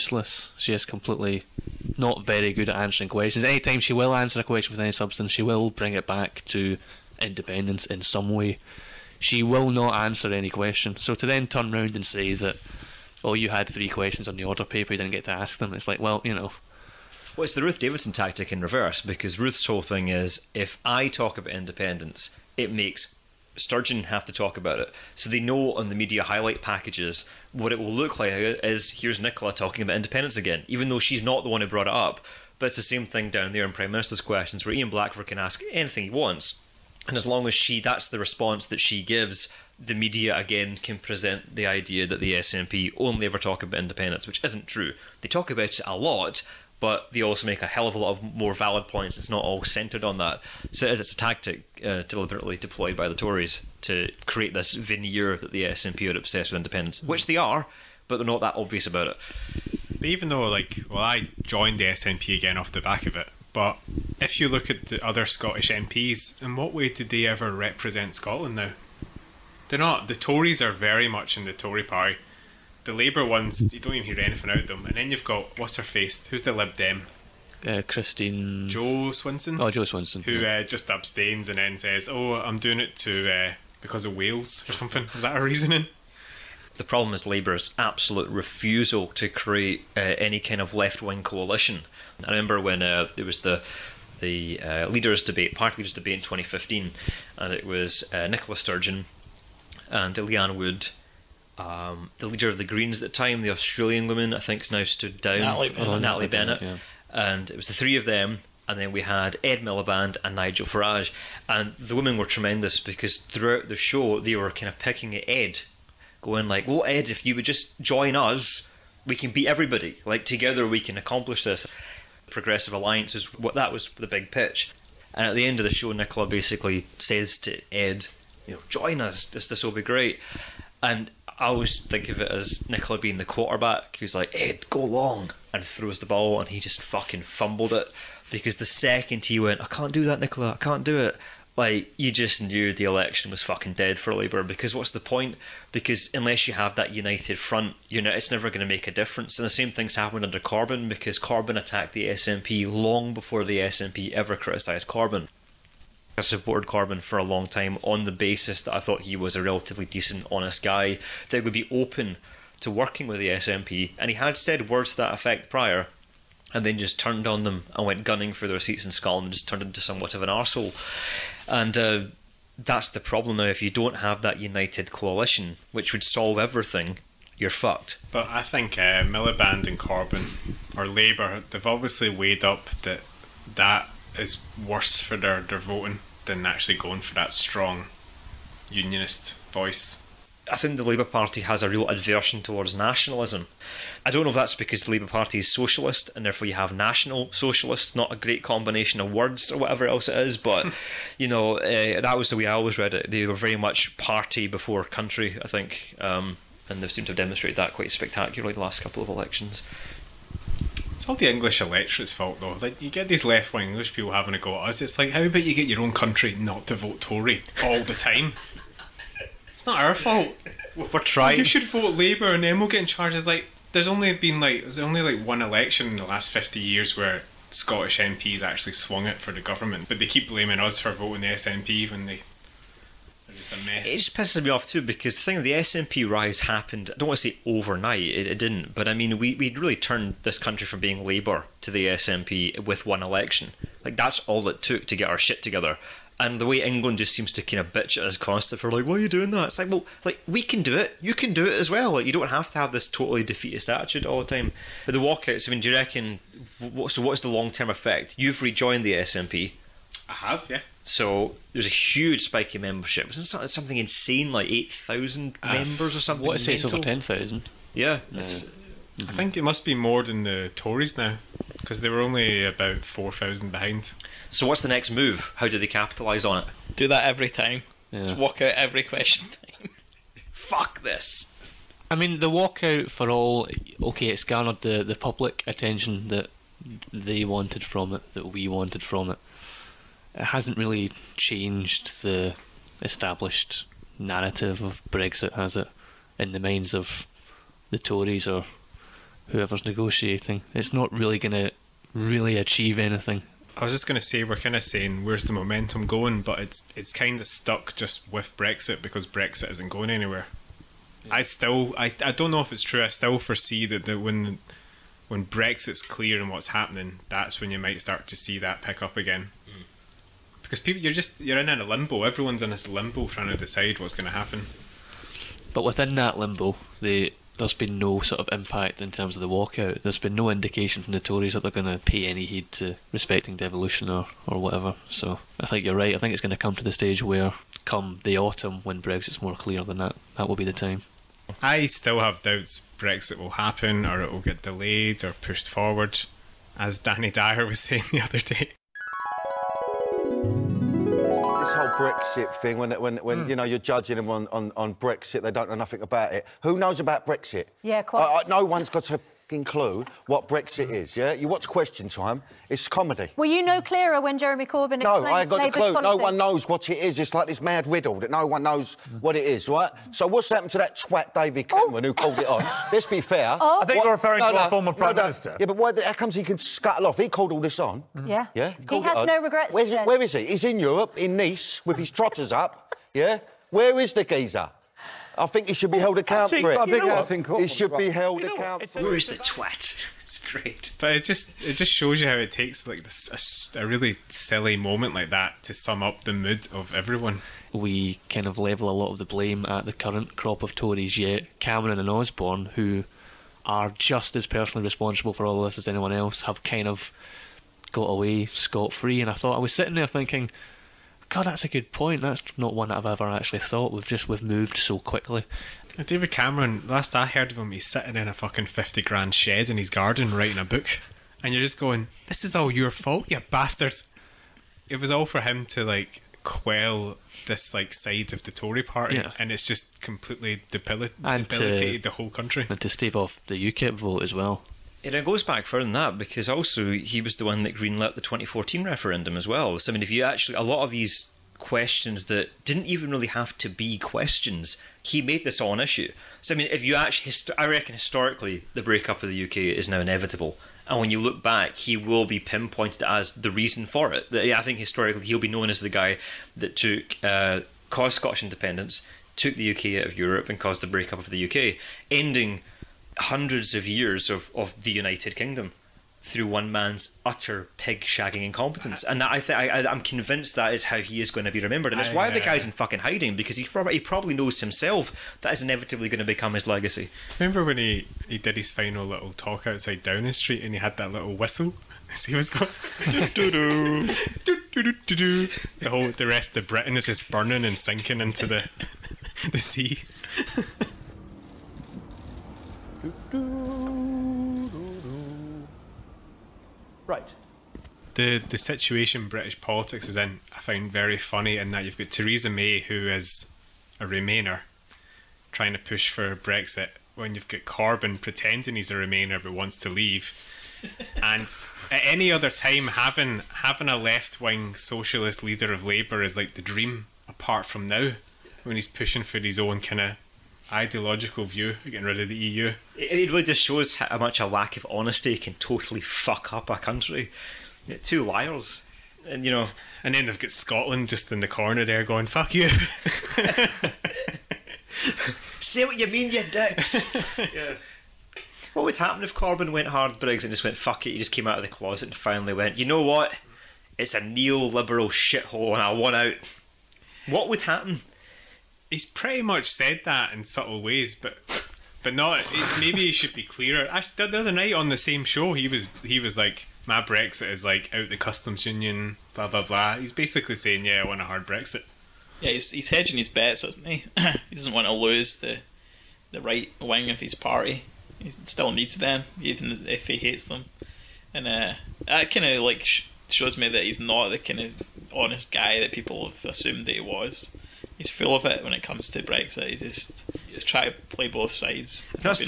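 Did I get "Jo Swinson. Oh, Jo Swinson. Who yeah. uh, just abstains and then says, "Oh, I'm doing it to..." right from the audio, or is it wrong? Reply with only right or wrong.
right.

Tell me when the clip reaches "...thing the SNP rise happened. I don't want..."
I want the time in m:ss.
3:55.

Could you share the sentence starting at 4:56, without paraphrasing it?
In the minds of the Tories or whoever's negotiating, it's not really going to really achieve anything.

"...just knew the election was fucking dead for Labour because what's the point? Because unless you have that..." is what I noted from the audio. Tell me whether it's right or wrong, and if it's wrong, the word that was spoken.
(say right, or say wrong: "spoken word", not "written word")
right.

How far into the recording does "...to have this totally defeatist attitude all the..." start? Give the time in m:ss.
4:12.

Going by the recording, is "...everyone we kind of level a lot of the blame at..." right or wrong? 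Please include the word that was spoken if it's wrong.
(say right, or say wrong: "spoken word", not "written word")
right.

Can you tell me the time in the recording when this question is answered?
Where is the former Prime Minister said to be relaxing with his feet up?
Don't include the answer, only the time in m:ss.
6:21.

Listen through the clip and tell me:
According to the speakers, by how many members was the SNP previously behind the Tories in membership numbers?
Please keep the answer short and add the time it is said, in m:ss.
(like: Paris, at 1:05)
4,000, at 4:32.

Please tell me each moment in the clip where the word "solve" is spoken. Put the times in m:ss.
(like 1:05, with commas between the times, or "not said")
2:56.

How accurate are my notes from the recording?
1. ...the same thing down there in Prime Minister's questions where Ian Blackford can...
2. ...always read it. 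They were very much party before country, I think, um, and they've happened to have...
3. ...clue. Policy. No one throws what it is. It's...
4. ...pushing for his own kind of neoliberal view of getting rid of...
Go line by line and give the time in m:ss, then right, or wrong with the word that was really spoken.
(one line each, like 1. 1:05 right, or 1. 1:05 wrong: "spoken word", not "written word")
1. 0:32 right
2. 3:22 wrong: "seemed", not "happened"
3. 6:05 wrong: "knows", not "throws"
4. 8:38 wrong: "ideological", not "neoliberal".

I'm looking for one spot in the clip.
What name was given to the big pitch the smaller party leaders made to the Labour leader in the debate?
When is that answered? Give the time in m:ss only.
2:02.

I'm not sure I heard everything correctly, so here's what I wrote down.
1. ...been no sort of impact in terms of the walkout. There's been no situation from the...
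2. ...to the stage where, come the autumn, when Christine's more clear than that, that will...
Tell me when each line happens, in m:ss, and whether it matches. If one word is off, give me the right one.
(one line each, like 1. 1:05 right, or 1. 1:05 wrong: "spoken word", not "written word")
1. 5:27 wrong: "indication", not "situation"
2. 5:36 wrong: "Brexit", not "Christine".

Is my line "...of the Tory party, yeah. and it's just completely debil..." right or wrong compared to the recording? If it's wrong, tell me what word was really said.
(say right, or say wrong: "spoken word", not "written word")
right.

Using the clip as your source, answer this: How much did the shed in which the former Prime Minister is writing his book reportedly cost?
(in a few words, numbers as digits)
50 grand.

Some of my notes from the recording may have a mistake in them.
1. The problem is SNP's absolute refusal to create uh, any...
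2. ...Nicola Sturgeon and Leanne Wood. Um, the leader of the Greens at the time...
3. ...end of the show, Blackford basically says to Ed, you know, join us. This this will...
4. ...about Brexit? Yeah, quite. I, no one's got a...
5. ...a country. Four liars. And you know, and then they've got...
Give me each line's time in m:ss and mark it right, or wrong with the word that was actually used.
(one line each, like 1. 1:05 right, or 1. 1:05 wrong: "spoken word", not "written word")
1. 1:26 wrong: "Labour", not "SNP"
2. 1:38 right
3. 2:05 wrong: "Nicola", not "Blackford"
4. 5:56 right
5. 8:46 wrong: "Two", not "Four".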